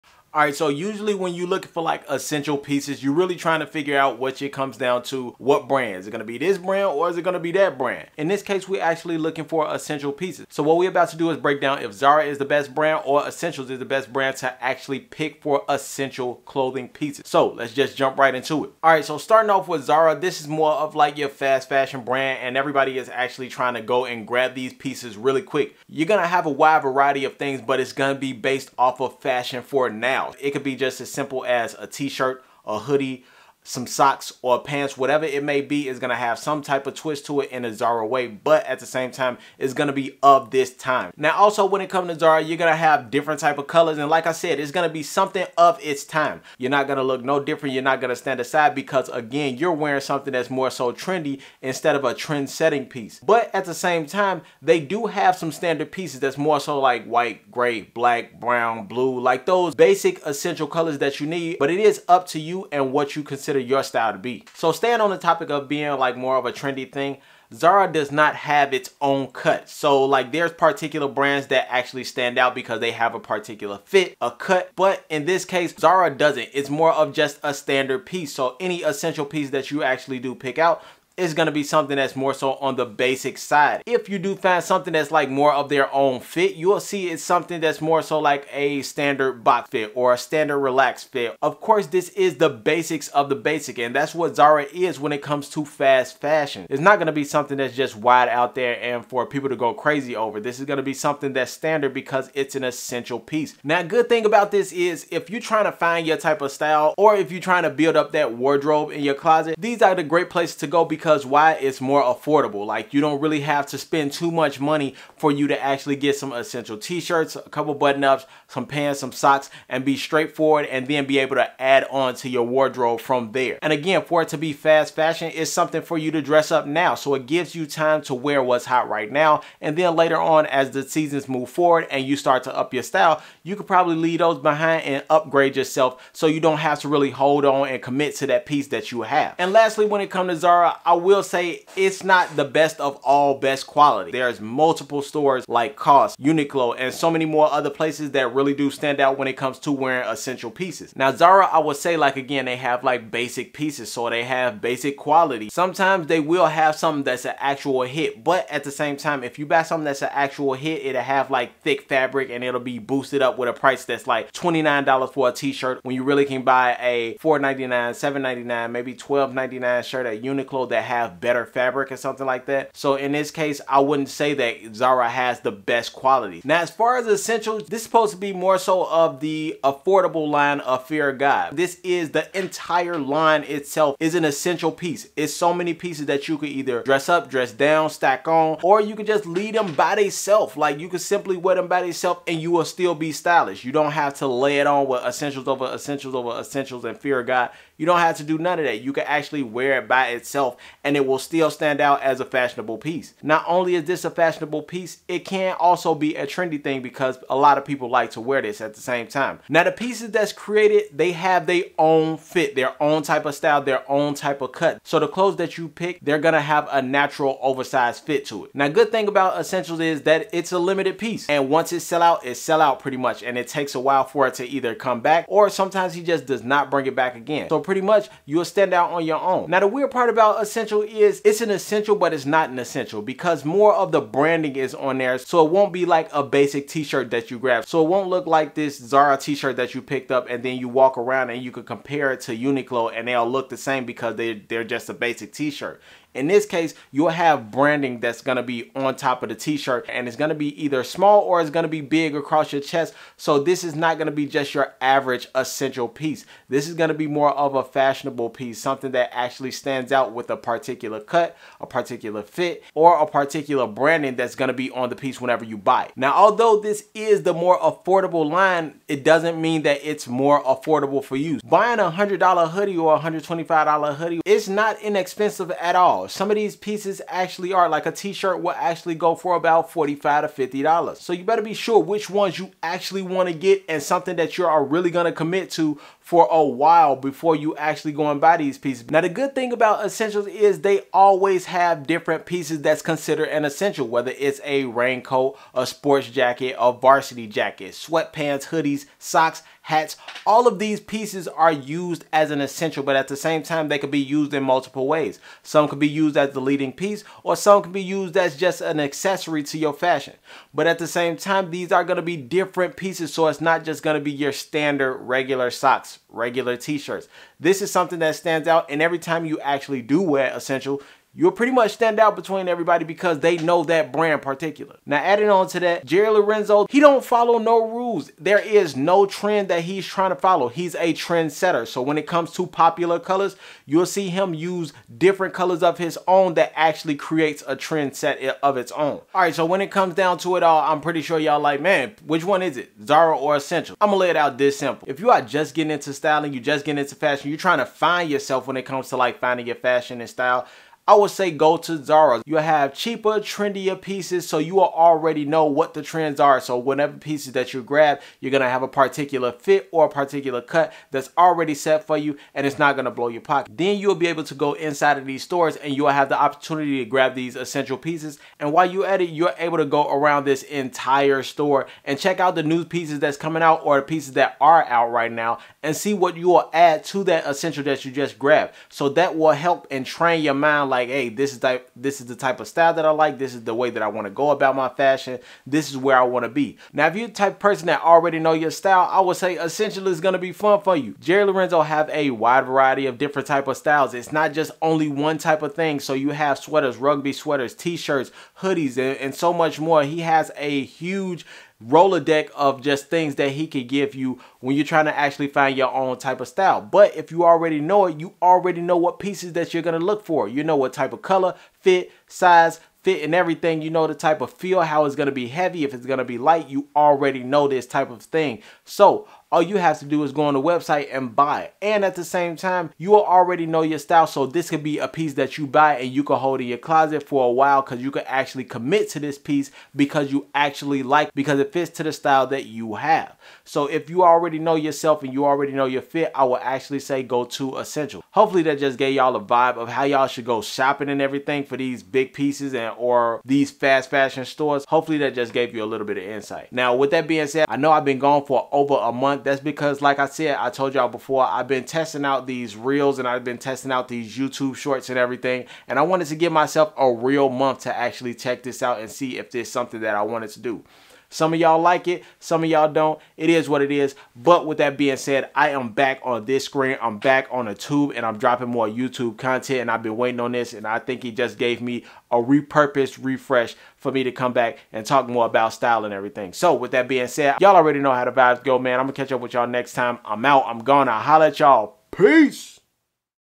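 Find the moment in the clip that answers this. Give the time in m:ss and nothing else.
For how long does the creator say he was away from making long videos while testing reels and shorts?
7:28.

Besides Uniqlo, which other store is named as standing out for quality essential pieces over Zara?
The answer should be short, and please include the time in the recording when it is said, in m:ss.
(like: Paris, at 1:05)
COS, at 2:25.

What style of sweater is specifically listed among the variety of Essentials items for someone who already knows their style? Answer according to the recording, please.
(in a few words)
Rugby sweaters.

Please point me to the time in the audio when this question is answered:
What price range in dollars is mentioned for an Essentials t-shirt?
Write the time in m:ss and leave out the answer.
4:39.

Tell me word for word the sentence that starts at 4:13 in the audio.
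So this is not gonna be just your average essential piece.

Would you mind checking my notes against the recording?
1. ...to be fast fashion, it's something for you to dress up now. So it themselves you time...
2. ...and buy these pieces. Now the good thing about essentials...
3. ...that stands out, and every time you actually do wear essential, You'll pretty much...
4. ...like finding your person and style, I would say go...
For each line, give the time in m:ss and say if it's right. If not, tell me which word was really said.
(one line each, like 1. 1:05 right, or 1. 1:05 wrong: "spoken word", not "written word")
1. 2:04 wrong: "gives", not "themselves"
2. 4:48 right
3. 5:17 right
4. 5:48 wrong: "fashion", not "person".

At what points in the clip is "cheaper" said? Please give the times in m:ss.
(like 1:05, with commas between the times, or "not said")
5:52.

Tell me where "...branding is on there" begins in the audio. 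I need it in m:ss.
3:54.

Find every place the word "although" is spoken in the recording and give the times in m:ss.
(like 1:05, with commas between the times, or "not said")
4:26.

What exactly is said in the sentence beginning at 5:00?
All of these pieces are used as an essential, but at the same time, they could be used in multiple ways.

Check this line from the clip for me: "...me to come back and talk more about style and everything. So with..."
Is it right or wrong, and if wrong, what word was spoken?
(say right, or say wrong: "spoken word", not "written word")
right.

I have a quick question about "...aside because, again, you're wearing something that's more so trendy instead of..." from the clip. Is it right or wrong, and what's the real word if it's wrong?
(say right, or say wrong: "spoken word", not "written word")
right.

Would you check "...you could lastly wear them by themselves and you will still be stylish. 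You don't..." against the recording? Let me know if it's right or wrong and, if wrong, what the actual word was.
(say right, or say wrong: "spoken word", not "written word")
wrong: "simply", not "lastly".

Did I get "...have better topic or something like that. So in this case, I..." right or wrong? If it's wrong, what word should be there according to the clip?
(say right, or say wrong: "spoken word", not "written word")
wrong: "fabric", not "topic".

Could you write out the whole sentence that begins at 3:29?
Now the pieces that's created, they have their own fit, their own type of style, their own type of cut.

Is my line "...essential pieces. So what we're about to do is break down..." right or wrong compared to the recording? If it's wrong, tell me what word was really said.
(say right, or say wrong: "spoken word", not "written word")
right.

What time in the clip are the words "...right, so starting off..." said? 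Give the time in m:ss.
0:18.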